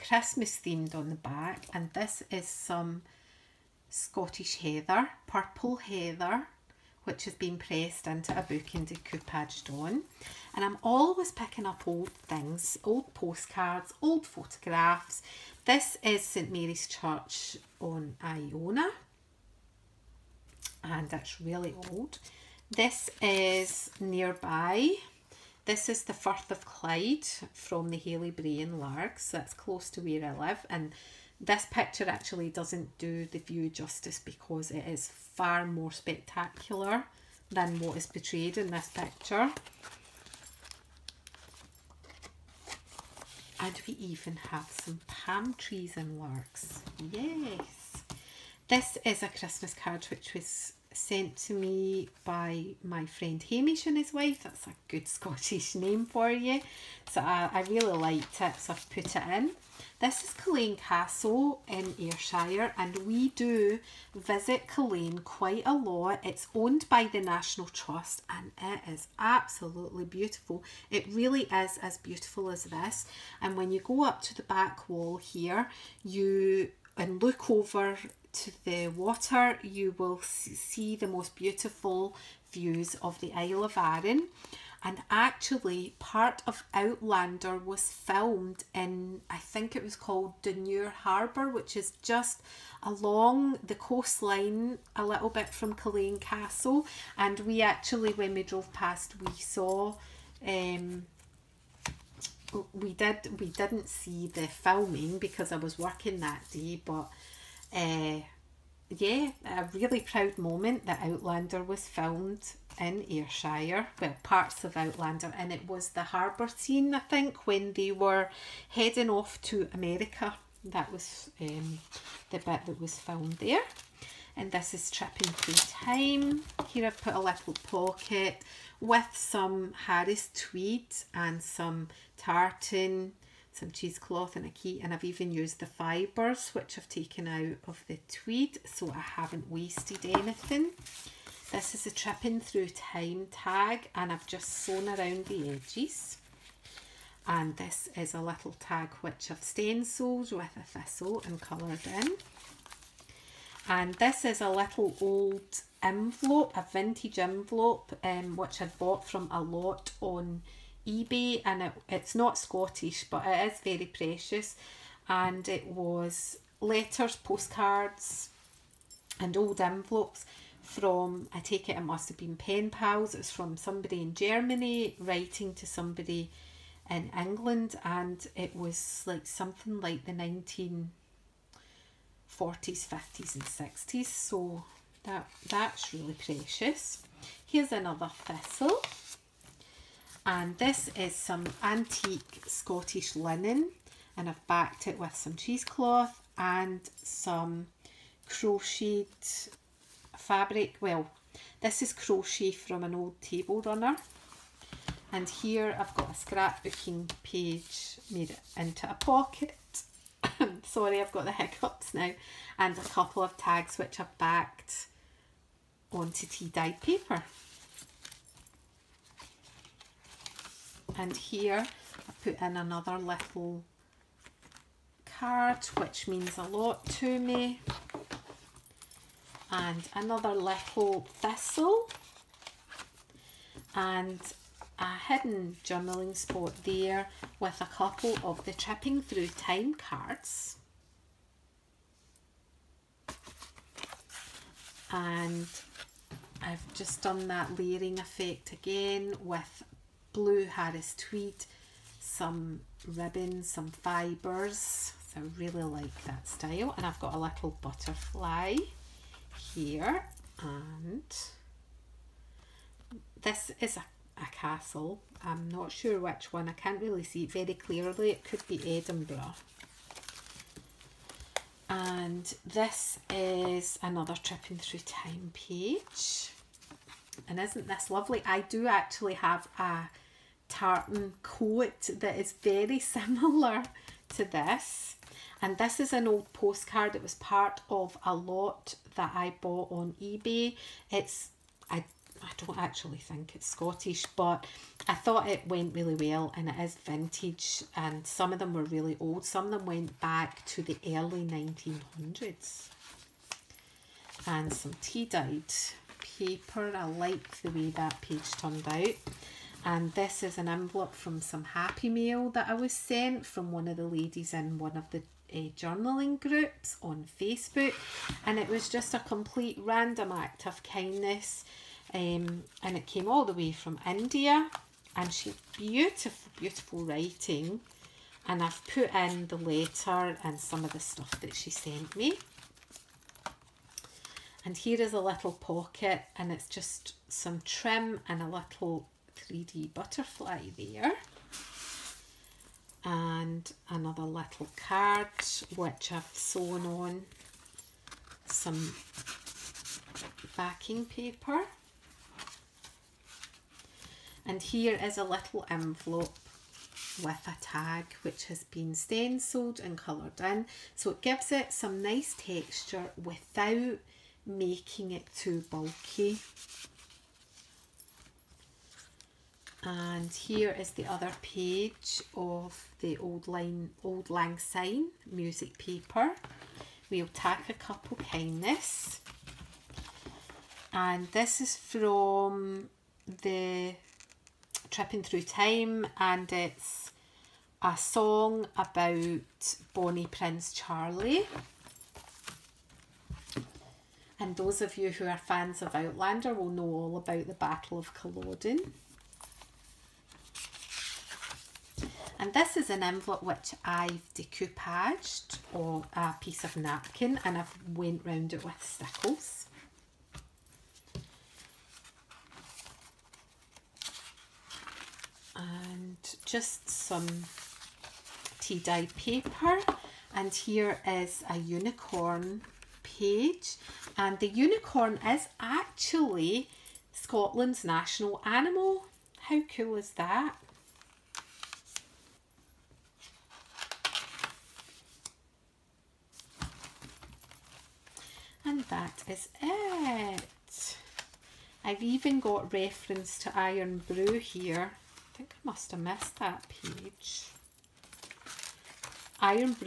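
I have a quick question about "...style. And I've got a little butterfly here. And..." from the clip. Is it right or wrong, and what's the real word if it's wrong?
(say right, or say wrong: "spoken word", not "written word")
right.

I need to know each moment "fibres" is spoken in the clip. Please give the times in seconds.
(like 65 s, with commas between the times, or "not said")
135 s, 253 s.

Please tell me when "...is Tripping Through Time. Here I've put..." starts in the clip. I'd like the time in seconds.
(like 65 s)
124 s.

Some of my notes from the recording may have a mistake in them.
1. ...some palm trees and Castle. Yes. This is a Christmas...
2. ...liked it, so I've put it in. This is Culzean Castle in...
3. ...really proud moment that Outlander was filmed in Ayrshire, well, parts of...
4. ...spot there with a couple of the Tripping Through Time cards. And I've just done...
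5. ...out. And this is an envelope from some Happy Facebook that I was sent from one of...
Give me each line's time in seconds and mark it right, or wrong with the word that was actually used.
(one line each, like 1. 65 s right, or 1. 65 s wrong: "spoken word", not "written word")
1. 44 s wrong: "Largs", not "Castle"
2. 57 s right
3. 109 s right
4. 236 s right
5. 308 s wrong: "Mail", not "Facebook".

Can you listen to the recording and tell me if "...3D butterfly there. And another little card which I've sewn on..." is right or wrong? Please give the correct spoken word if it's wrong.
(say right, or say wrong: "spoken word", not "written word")
right.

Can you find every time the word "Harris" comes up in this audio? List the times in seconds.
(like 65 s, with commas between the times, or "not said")
129 s, 250 s.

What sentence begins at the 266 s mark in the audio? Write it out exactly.
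I can't really see it very clearly.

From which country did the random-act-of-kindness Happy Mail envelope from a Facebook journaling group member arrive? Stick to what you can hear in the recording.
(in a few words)
India.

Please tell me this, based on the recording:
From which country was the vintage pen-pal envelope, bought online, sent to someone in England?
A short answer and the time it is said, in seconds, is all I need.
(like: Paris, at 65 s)
Germany, at 174 s.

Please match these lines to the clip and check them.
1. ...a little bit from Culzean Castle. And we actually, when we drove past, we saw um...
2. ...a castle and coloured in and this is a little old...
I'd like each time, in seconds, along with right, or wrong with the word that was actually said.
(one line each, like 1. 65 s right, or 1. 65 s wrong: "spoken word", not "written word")
1. 94 s right
2. 150 s wrong: "thistle", not "castle".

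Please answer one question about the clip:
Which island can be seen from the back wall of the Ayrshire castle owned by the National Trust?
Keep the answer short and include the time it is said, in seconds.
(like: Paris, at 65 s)
Isle of Arran, at 83 s.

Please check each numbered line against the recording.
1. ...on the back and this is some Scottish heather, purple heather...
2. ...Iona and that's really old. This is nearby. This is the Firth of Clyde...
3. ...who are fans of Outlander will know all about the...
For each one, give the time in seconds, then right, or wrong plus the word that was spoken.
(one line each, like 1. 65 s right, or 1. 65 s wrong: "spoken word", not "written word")
1. 0 s right
2. 18 s right
3. 394 s right.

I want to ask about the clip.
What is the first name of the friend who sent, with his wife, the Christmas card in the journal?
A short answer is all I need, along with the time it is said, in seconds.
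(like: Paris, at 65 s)
Hamish, at 53 s.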